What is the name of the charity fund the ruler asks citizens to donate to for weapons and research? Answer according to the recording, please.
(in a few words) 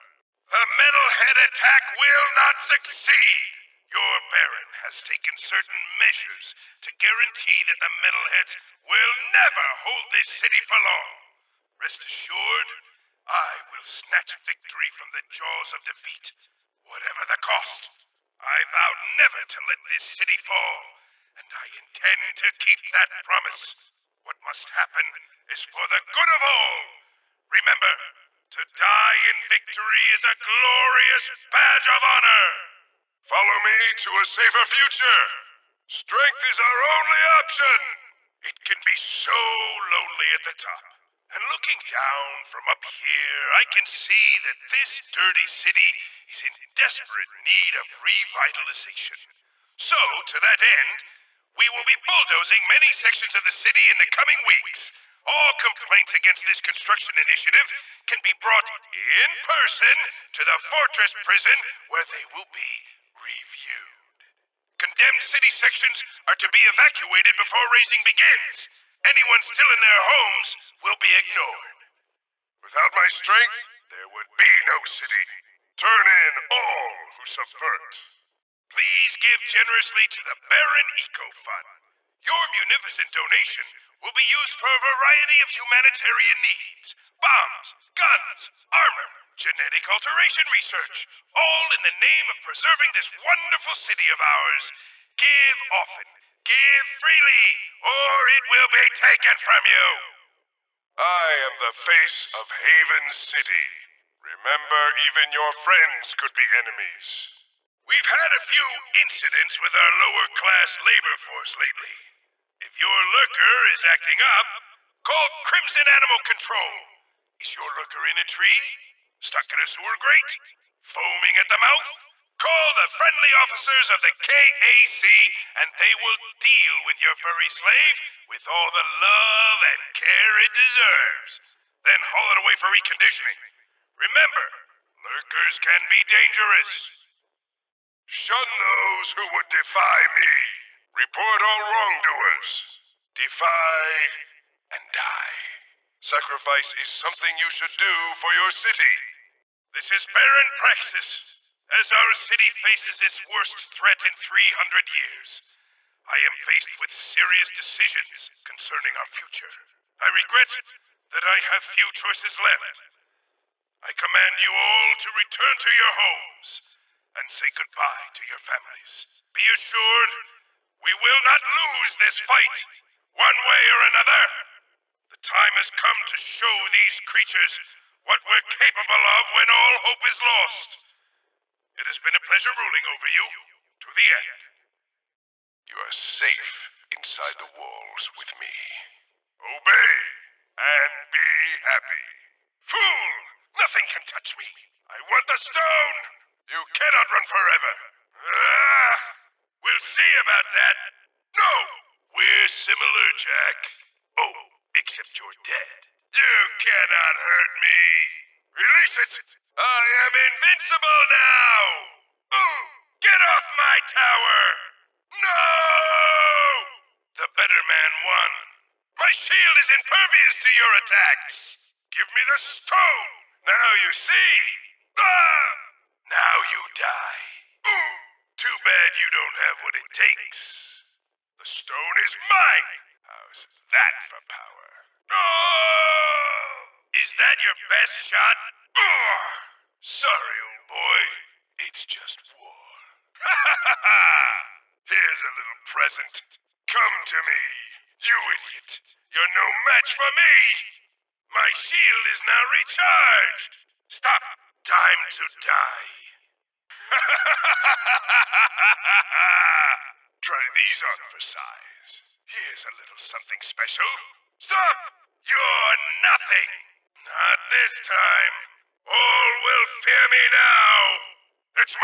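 Baron Eco Fund.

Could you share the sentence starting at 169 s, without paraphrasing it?
Be assured, we will not lose this fight, one way or another.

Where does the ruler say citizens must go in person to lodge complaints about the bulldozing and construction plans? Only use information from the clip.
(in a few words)
Fortress Prison.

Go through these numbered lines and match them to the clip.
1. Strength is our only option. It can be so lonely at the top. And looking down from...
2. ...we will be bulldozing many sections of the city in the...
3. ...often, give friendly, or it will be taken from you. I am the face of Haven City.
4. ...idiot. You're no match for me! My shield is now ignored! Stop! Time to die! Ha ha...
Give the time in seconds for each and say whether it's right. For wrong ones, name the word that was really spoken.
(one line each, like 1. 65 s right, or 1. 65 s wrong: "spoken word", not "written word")
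1. 35 s right
2. 51 s right
3. 95 s wrong: "freely", not "friendly"
4. 248 s wrong: "recharged", not "ignored".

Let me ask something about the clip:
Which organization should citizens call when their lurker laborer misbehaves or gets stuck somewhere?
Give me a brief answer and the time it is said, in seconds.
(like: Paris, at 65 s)
Krimzon Animal Control, at 115 s.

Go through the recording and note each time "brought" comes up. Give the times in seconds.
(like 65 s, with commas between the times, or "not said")
58 s.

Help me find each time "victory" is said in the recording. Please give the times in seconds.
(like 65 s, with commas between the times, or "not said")
14 s, 29 s.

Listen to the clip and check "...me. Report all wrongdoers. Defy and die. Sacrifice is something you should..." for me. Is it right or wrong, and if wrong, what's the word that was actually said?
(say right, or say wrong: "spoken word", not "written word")
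right.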